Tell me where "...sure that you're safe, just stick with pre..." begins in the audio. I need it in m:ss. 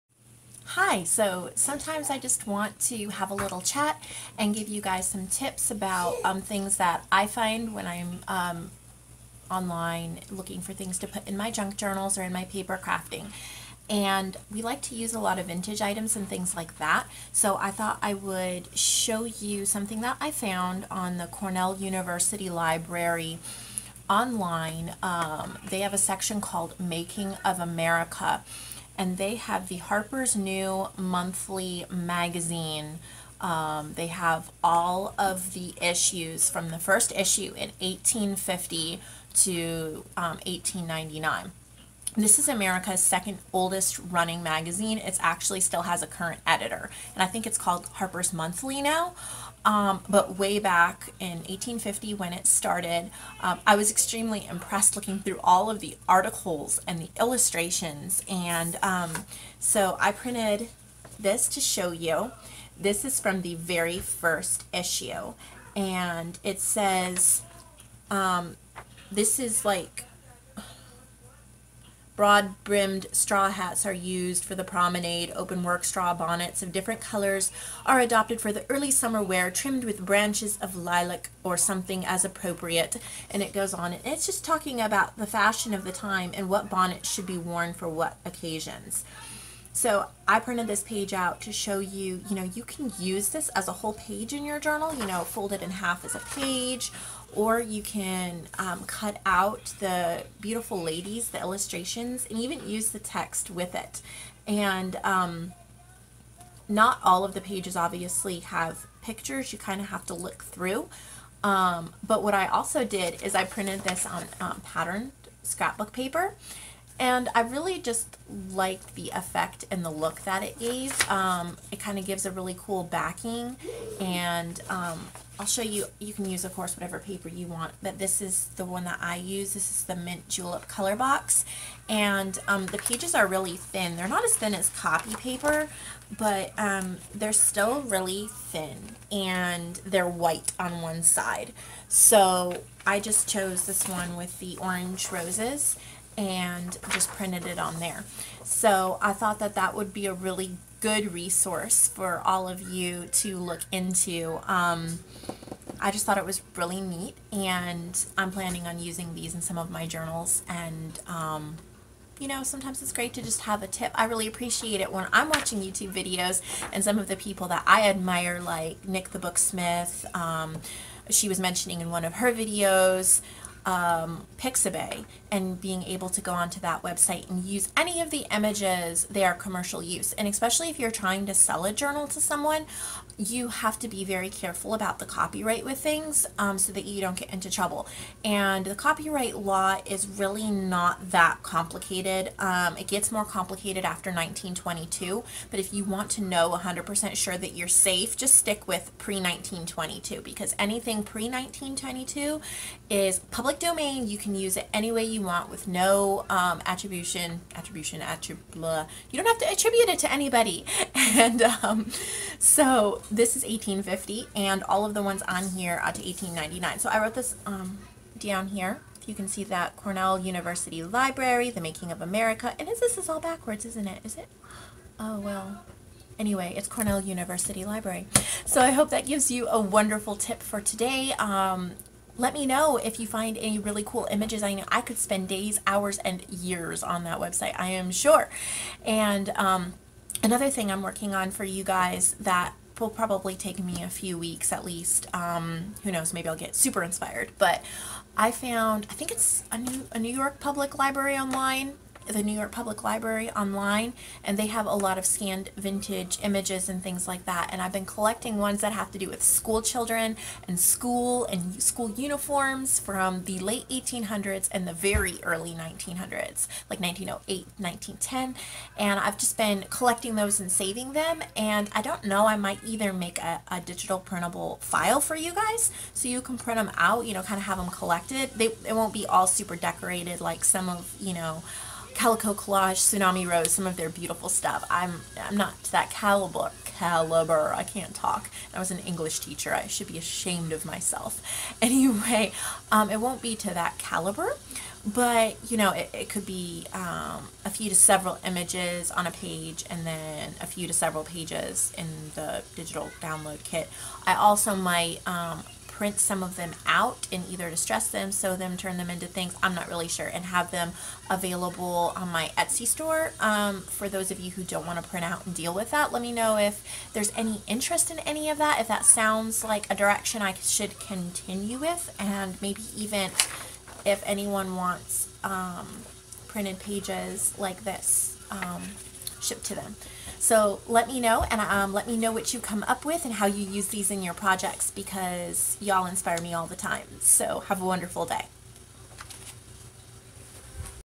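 3:17.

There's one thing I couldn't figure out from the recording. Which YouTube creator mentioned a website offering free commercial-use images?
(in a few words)
Nik the Booksmith.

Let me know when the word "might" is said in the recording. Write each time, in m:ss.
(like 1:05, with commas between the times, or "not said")
4:32, 5:04.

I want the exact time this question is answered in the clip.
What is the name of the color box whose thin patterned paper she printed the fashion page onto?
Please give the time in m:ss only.
2:09.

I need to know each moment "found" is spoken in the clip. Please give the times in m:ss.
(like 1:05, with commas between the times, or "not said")
0:20, 4:08.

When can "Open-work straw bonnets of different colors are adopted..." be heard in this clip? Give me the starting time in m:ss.
1:15.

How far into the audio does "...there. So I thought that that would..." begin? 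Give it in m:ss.
2:27.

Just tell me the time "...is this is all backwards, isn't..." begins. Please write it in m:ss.
3:42.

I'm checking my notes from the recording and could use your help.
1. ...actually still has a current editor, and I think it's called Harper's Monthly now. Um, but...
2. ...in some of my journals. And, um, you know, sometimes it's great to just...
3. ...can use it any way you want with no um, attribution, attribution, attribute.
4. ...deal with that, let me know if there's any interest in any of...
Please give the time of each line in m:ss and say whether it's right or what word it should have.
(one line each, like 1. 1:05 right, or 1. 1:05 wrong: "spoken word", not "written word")
1. 0:45 right
2. 2:39 right
3. 3:24 right
4. 5:15 right.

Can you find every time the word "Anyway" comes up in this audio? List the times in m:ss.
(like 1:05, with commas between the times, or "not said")
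3:46, 4:51.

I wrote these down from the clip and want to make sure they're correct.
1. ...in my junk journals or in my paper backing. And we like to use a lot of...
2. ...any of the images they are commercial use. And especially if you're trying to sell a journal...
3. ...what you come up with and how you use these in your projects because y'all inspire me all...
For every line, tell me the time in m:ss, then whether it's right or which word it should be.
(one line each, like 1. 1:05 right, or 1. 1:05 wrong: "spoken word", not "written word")
1. 0:11 wrong: "crafting", not "backing"
2. 2:57 right
3. 5:32 right.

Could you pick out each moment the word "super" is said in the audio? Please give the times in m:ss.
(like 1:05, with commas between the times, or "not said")
4:06, 4:39.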